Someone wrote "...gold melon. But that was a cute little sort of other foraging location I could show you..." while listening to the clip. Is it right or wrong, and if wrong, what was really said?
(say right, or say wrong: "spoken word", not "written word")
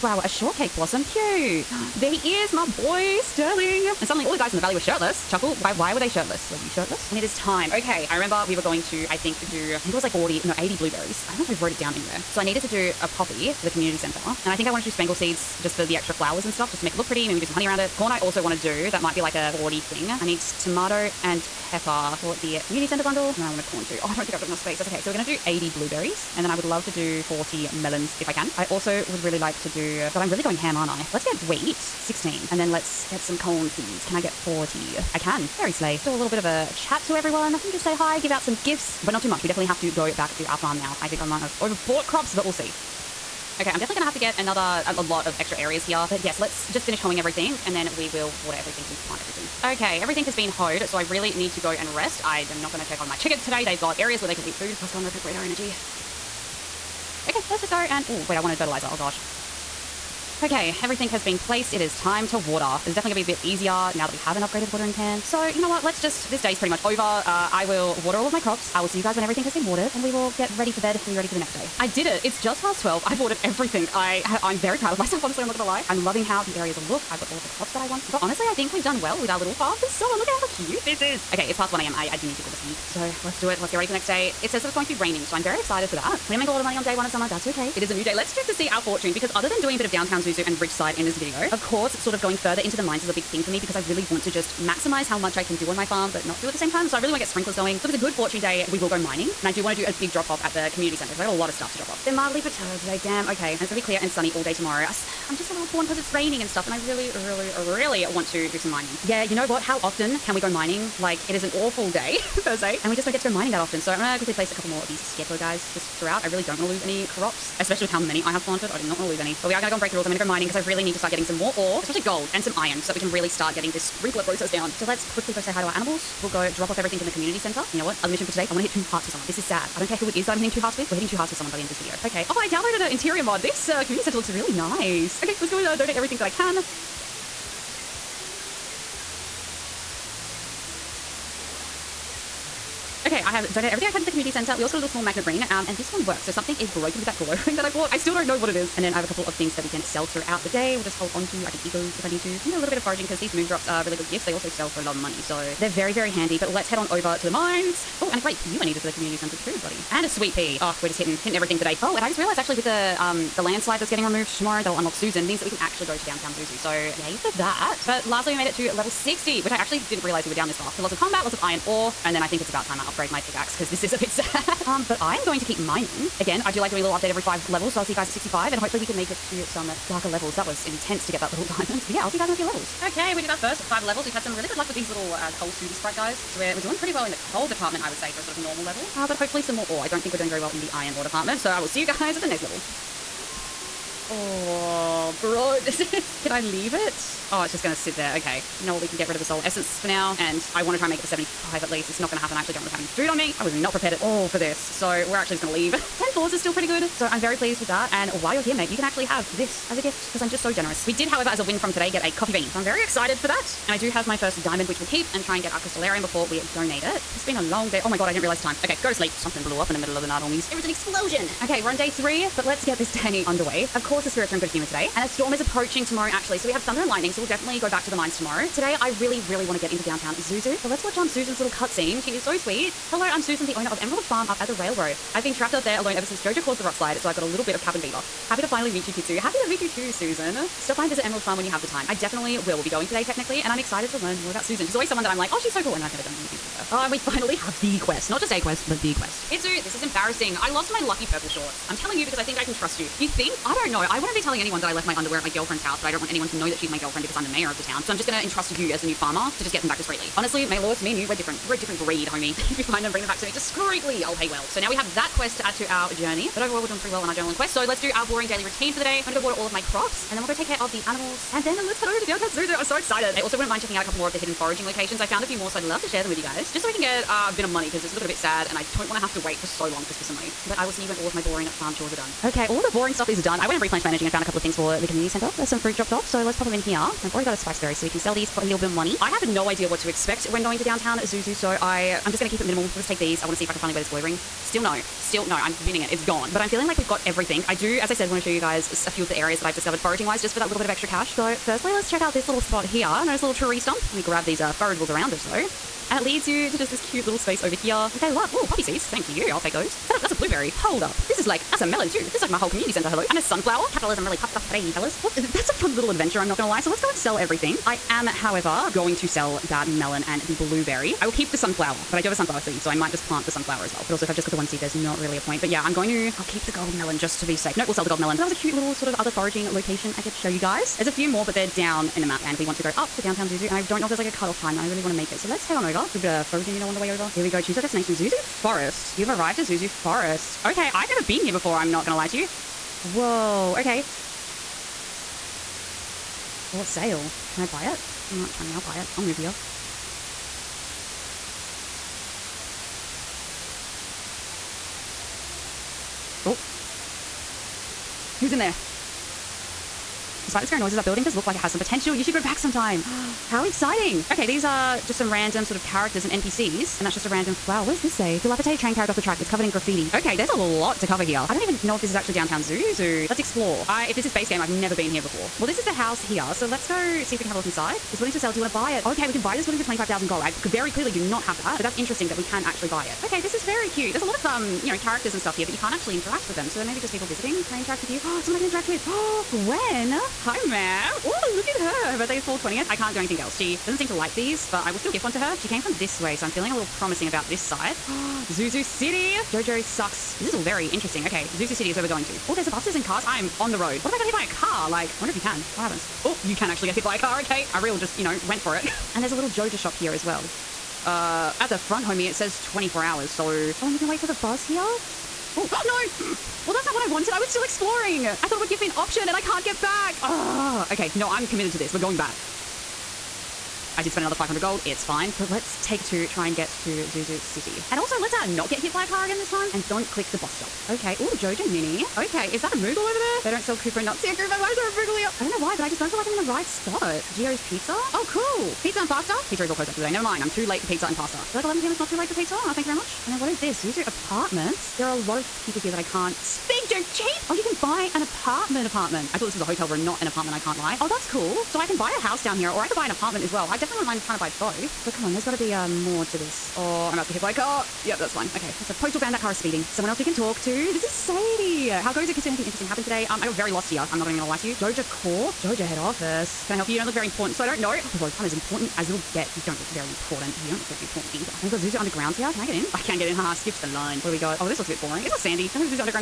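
right.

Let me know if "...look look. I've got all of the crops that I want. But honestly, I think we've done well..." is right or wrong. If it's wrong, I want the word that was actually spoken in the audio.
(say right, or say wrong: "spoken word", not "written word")
right.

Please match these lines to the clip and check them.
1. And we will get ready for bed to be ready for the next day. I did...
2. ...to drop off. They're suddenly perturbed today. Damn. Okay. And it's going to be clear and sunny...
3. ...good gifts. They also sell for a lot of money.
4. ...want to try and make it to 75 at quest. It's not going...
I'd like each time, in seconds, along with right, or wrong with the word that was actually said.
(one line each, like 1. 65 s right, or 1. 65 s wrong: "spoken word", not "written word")
1. 69 s right
2. 101 s wrong: "mildly", not "suddenly"
3. 153 s right
4. 200 s wrong: "least", not "quest".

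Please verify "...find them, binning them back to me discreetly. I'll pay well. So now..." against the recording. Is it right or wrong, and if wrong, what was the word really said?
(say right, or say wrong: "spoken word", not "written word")
wrong: "bring", not "binning".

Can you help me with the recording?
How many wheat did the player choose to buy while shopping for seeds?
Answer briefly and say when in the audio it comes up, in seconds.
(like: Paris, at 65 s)
16, at 31 s.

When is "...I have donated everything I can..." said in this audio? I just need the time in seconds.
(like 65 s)
143 s.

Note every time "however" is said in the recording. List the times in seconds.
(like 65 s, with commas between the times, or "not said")
211 s, 318 s.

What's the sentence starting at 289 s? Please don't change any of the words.
I have no idea what to expect when going to downtown Zuzu, so I, I'm just going to keep it minimal.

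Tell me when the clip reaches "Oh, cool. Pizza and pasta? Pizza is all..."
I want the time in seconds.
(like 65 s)
437 s.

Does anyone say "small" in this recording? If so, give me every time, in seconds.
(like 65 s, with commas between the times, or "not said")
144 s.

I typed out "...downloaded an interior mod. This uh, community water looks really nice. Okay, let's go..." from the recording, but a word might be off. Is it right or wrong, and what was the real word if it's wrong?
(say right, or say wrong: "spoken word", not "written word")
wrong: "center", not "water".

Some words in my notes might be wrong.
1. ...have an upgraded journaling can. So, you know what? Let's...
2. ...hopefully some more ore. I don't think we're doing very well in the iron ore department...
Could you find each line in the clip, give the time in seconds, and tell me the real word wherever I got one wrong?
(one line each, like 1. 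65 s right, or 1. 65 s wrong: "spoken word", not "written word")
1. 64 s wrong: "watering", not "journaling"
2. 189 s right.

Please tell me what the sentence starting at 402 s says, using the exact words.
Oh, there's the buses and cars.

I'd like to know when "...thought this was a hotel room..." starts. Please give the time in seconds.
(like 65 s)
449 s.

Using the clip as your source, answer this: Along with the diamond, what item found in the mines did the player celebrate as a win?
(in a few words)
coffee bean.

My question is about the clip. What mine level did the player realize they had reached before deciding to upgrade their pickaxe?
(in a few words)
60.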